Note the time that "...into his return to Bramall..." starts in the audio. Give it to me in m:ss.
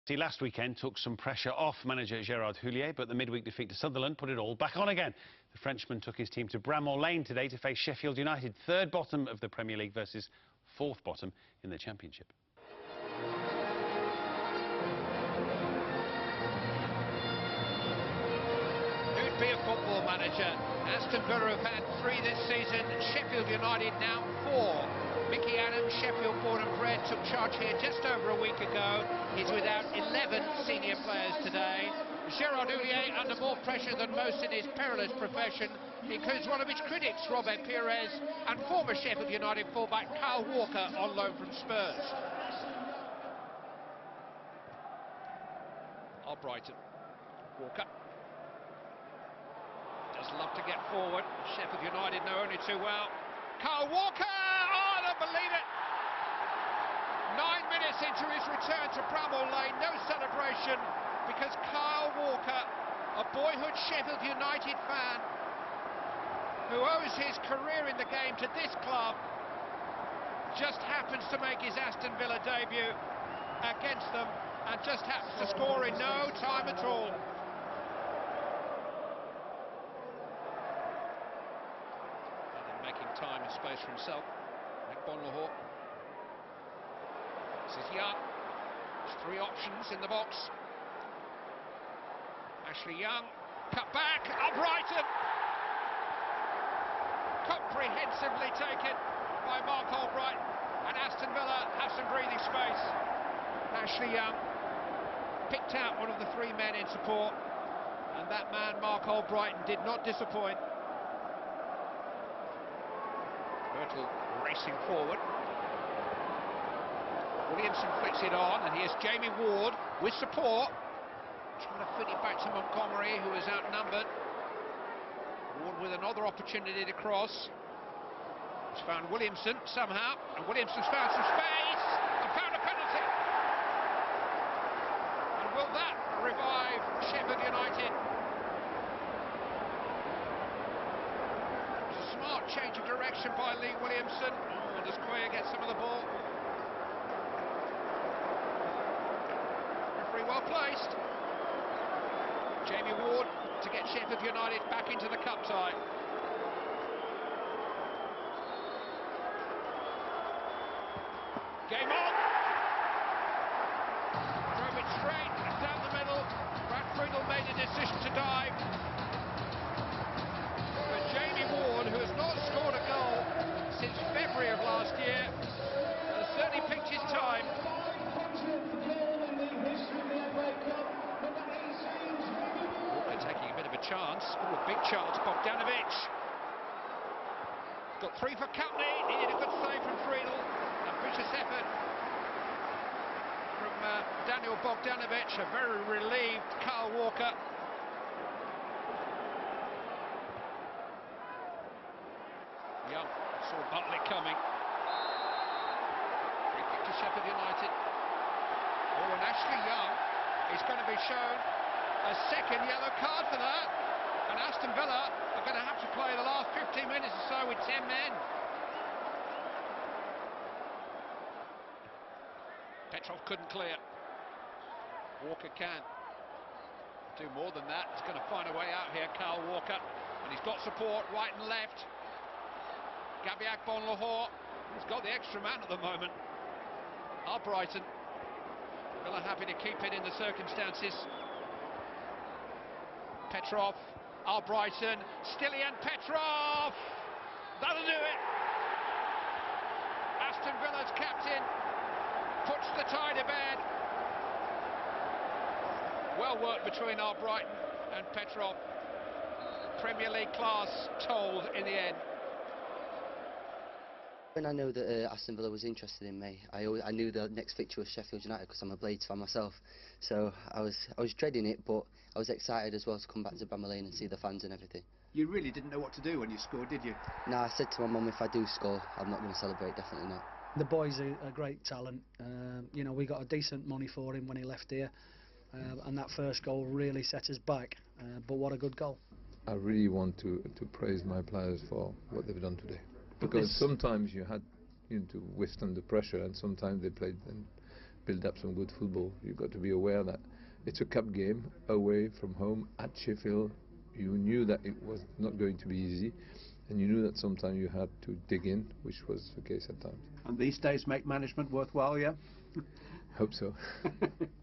0:58.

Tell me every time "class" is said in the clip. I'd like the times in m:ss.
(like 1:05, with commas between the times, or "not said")
4:20.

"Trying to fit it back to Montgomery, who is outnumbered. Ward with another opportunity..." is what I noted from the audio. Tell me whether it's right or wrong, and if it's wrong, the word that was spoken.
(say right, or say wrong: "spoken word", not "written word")
right.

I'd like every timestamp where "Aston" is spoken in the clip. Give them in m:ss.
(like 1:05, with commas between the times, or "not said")
0:20, 1:11, 1:40, 3:34, 4:10, 4:25.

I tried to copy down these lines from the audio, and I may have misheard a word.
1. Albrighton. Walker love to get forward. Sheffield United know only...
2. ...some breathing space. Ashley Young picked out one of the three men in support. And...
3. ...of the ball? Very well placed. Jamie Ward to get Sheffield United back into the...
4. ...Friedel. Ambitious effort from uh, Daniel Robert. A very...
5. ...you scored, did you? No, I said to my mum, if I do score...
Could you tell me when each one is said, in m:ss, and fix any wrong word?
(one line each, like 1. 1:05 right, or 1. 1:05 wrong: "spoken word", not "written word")
1. 0:46 right
2. 1:41 right
3. 2:25 right
4. 3:10 wrong: "Bogdanovic", not "Robert"
5. 4:36 right.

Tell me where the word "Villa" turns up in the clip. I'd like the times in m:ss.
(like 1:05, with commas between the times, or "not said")
0:21, 1:12, 1:41, 3:34, 3:59, 4:10, 4:25.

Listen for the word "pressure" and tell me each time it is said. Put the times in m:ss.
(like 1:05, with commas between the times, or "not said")
0:01, 0:33, 4:55.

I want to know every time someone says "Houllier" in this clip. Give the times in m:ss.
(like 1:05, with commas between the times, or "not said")
0:02, 0:32.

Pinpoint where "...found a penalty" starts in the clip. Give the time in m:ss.
2:12.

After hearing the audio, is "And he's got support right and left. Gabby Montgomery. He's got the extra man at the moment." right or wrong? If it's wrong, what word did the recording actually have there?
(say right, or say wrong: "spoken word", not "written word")
wrong: "Agbonlahor", not "Montgomery".